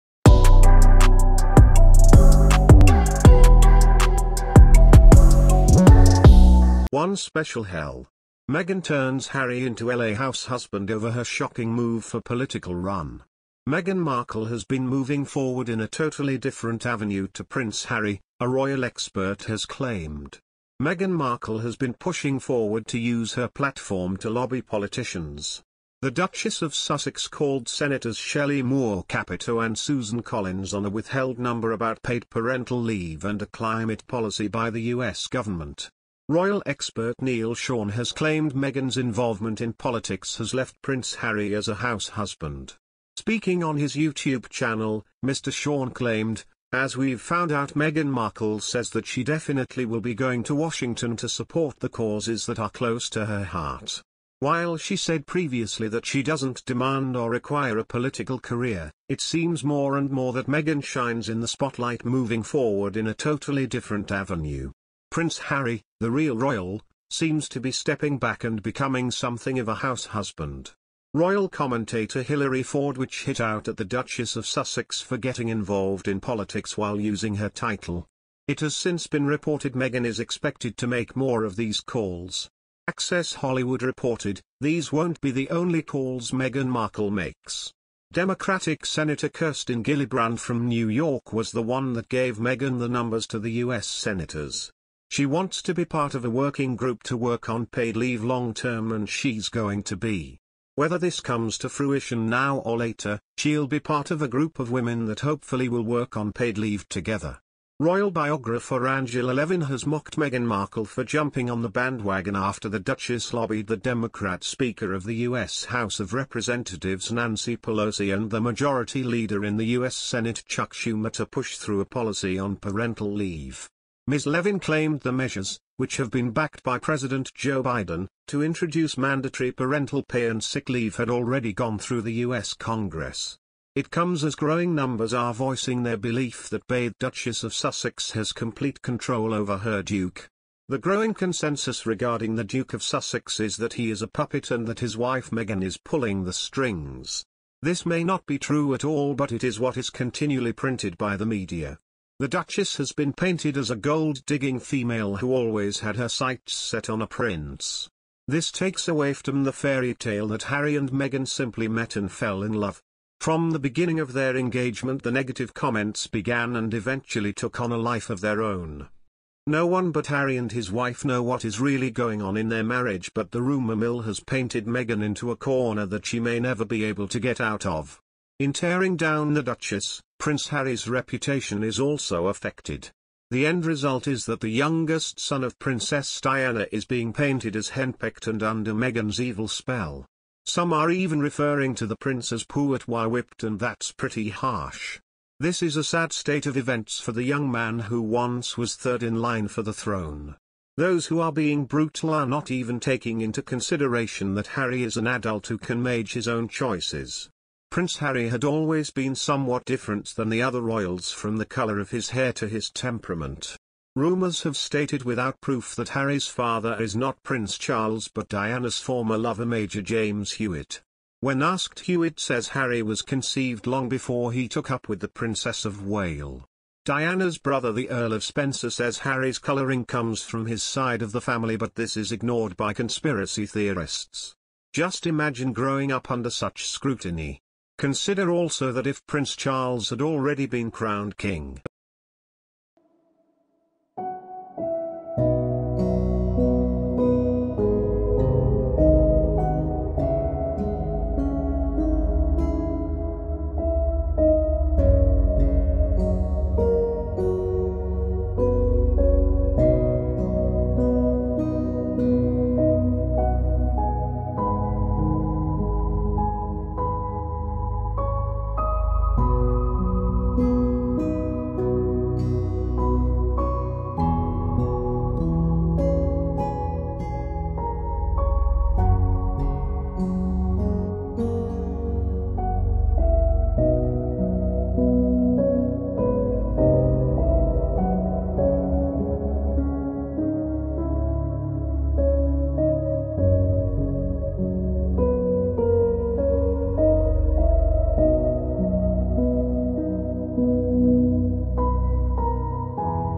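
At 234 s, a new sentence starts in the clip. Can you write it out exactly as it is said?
Just imagine growing up under such scrutiny.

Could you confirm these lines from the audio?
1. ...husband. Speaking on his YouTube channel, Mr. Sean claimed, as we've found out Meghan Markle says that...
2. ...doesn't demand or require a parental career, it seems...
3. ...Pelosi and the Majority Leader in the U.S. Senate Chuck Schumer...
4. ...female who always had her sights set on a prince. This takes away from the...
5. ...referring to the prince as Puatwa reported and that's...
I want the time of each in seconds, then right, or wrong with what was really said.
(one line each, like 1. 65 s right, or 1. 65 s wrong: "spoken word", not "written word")
1. 42 s right
2. 56 s wrong: "political", not "parental"
3. 117 s right
4. 154 s right
5. 191 s wrong: "whipped", not "reported".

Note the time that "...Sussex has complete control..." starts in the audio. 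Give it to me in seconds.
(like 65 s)
137 s.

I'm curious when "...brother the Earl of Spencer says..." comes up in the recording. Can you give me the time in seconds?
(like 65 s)
227 s.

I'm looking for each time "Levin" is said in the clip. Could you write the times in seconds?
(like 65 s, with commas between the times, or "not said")
109 s, 124 s.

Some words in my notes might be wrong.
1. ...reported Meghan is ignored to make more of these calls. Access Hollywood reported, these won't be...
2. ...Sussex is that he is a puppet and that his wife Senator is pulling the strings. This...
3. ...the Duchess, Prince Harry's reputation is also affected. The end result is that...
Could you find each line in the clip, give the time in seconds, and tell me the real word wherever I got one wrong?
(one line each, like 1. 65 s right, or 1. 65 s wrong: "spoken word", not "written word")
1. 79 s wrong: "expected", not "ignored"
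2. 142 s wrong: "Meghan", not "Senator"
3. 179 s right.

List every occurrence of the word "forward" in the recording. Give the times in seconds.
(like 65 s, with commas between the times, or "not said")
15 s, 22 s, 62 s.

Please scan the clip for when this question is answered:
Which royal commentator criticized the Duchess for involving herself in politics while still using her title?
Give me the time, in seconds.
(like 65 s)
72 s.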